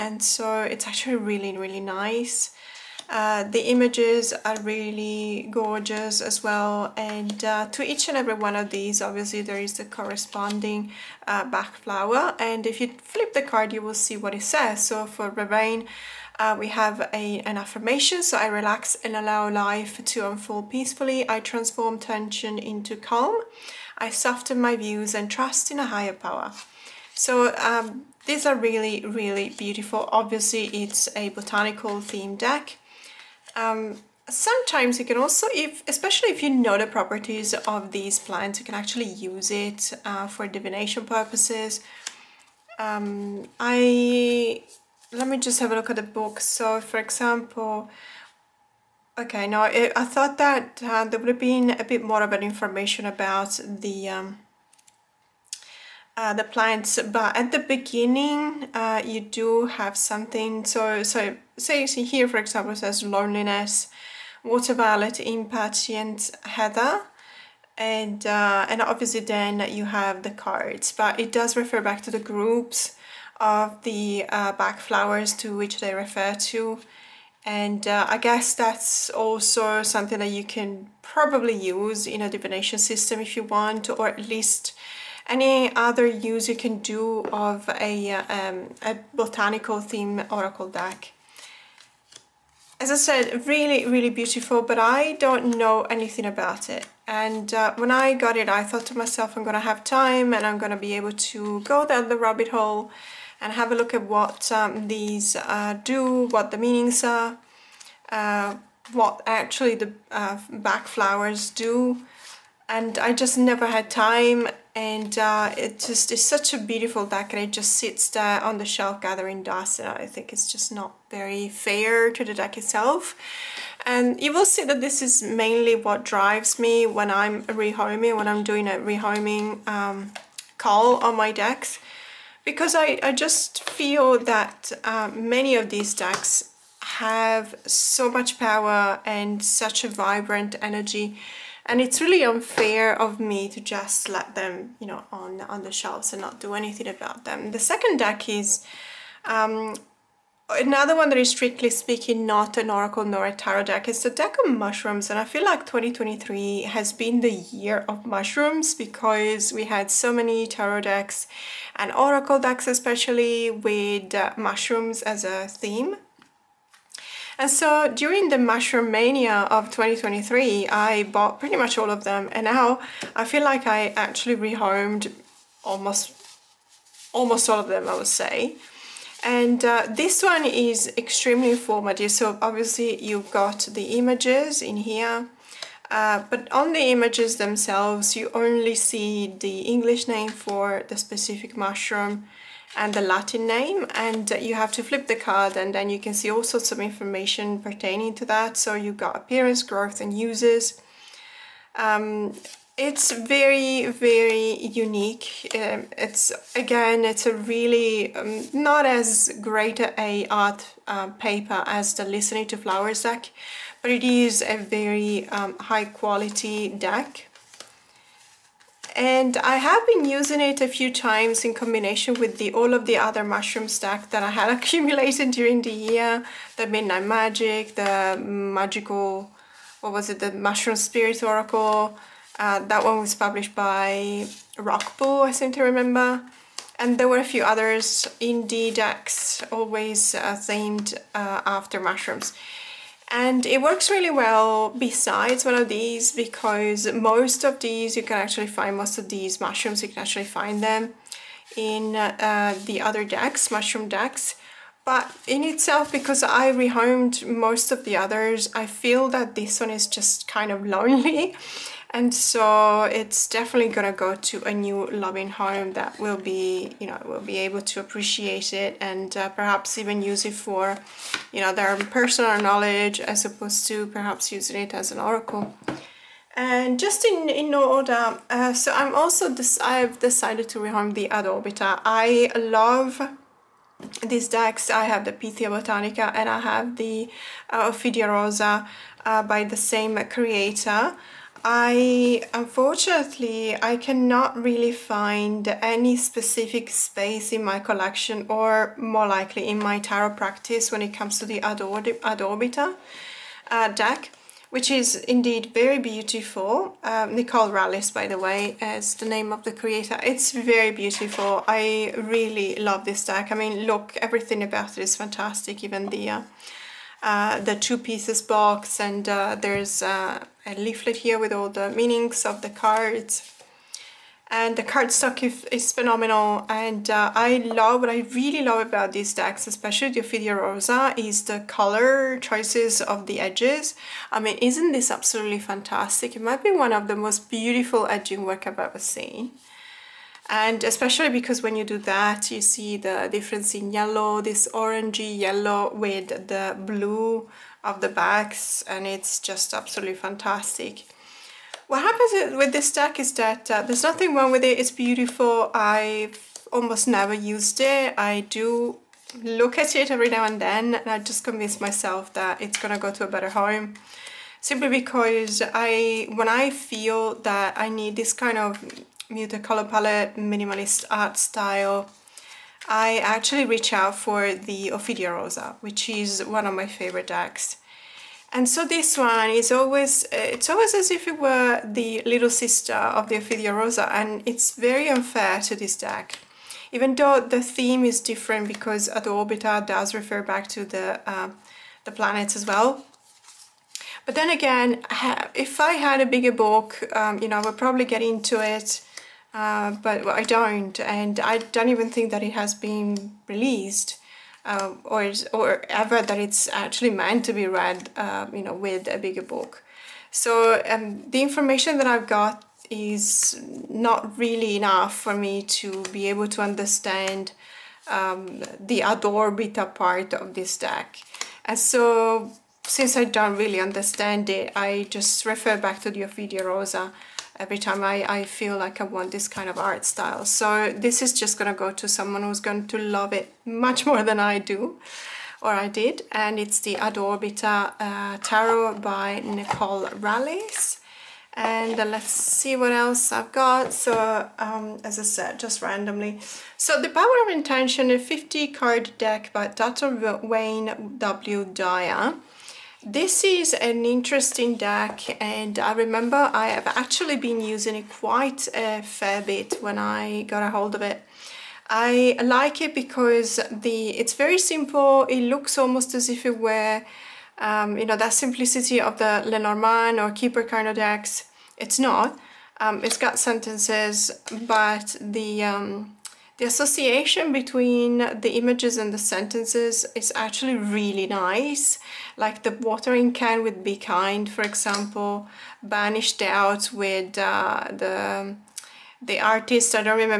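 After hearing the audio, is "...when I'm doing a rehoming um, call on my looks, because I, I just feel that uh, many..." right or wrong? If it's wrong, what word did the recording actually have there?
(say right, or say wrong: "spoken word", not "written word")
wrong: "decks", not "looks".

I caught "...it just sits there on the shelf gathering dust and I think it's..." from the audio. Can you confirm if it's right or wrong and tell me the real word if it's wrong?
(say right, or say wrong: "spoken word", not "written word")
right.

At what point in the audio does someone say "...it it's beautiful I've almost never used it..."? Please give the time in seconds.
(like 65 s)
354 s.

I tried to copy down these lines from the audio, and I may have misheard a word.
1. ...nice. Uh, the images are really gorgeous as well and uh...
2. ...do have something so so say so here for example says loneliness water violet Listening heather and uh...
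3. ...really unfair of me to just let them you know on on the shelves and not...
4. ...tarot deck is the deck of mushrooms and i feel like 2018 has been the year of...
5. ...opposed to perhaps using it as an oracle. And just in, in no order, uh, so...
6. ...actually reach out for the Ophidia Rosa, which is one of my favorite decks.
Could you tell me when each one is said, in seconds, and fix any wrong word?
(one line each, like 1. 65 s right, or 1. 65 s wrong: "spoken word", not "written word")
1. 1 s right
2. 59 s wrong: "Impatiens", not "Listening"
3. 142 s right
4. 153 s wrong: "2023", not "2018"
5. 273 s right
6. 372 s right.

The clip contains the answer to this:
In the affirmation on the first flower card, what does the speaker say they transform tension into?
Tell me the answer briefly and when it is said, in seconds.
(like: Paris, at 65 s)
calm, at 21 s.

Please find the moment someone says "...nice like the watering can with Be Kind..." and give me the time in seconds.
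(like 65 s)
481 s.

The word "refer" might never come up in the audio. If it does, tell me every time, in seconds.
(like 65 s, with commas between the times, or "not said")
71 s, 75 s, 389 s, 425 s.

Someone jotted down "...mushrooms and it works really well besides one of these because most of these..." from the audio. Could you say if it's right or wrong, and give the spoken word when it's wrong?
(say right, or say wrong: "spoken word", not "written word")
right.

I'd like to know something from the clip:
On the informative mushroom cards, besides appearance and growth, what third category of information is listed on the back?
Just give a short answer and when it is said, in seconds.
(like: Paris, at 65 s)
uses, at 200 s.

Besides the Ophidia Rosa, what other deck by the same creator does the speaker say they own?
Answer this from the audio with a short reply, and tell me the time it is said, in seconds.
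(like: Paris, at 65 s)
Pythia Botanica, at 285 s.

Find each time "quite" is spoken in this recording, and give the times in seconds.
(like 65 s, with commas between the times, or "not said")
457 s.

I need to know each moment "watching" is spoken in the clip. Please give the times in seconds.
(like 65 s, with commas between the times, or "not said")
not said.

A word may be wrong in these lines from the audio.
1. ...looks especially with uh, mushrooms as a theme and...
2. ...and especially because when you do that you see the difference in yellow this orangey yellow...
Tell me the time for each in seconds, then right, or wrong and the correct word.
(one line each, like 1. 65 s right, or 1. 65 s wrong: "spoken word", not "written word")
1. 162 s wrong: "decks", not "looks"
2. 340 s right.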